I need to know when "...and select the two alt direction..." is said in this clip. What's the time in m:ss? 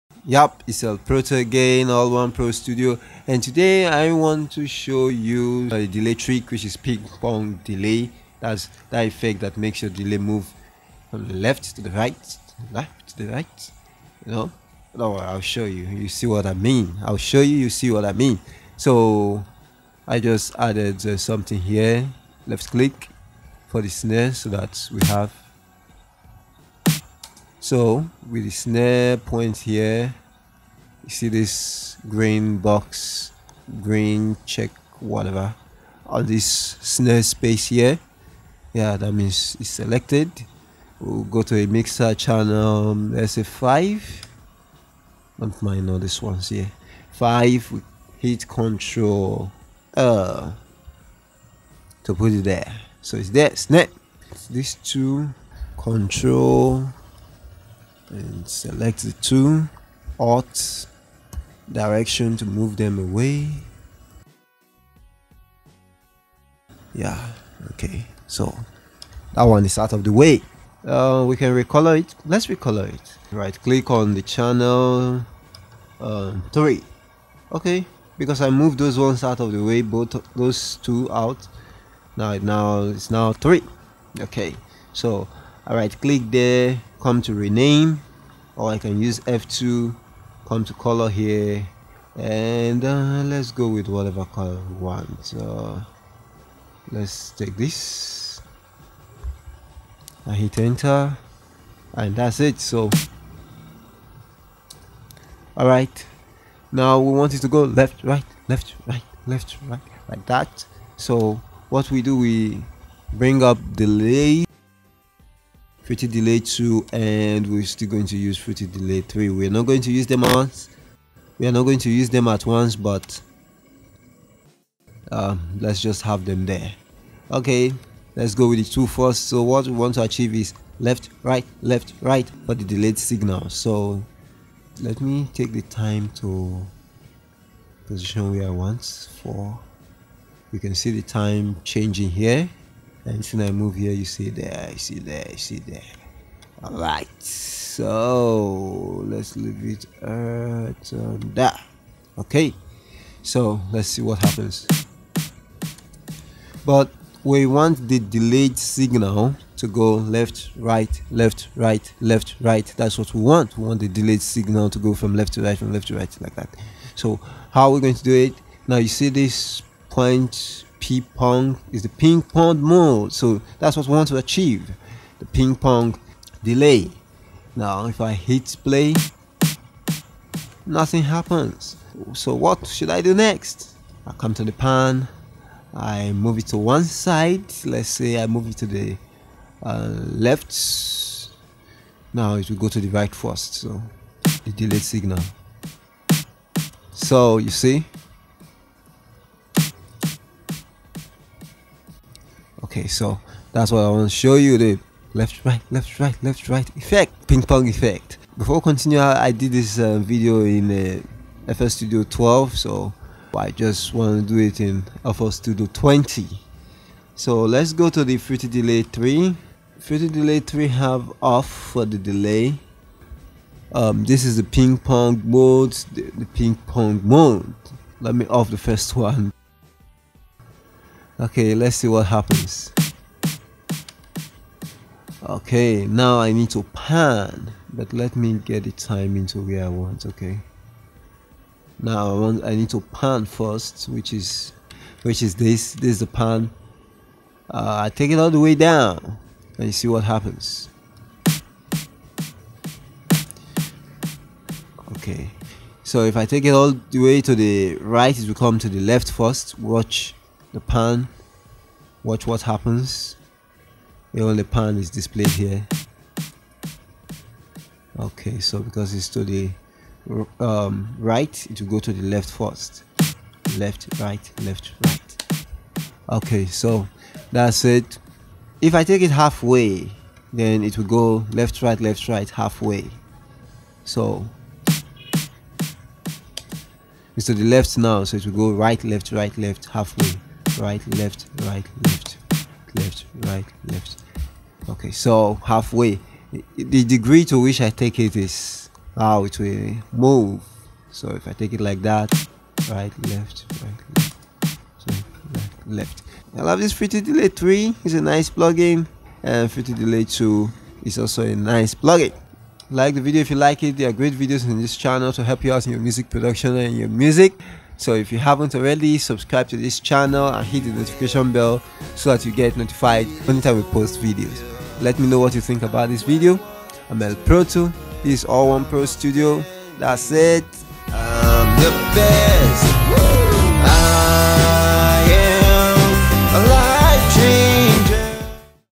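0:58.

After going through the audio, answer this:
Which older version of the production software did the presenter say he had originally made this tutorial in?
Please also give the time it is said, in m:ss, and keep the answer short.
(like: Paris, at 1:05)
FL Studio 12, at 3:31.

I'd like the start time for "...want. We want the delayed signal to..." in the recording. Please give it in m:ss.
2:43.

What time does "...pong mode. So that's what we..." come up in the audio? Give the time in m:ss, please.
2:52.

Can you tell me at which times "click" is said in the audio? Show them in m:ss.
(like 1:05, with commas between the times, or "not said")
0:22, 1:13, 1:26.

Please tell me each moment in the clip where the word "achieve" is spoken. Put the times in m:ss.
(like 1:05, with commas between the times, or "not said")
2:10, 2:54.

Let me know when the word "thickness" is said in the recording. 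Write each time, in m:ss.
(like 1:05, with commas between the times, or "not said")
not said.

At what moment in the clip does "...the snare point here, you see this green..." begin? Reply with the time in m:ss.
0:28.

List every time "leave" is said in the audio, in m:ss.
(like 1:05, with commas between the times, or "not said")
2:29.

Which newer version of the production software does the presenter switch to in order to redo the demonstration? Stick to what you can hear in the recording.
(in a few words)
FL Studio 20.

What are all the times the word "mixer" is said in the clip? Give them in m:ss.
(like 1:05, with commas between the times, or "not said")
0:41.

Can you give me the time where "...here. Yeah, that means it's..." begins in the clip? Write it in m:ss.
0:37.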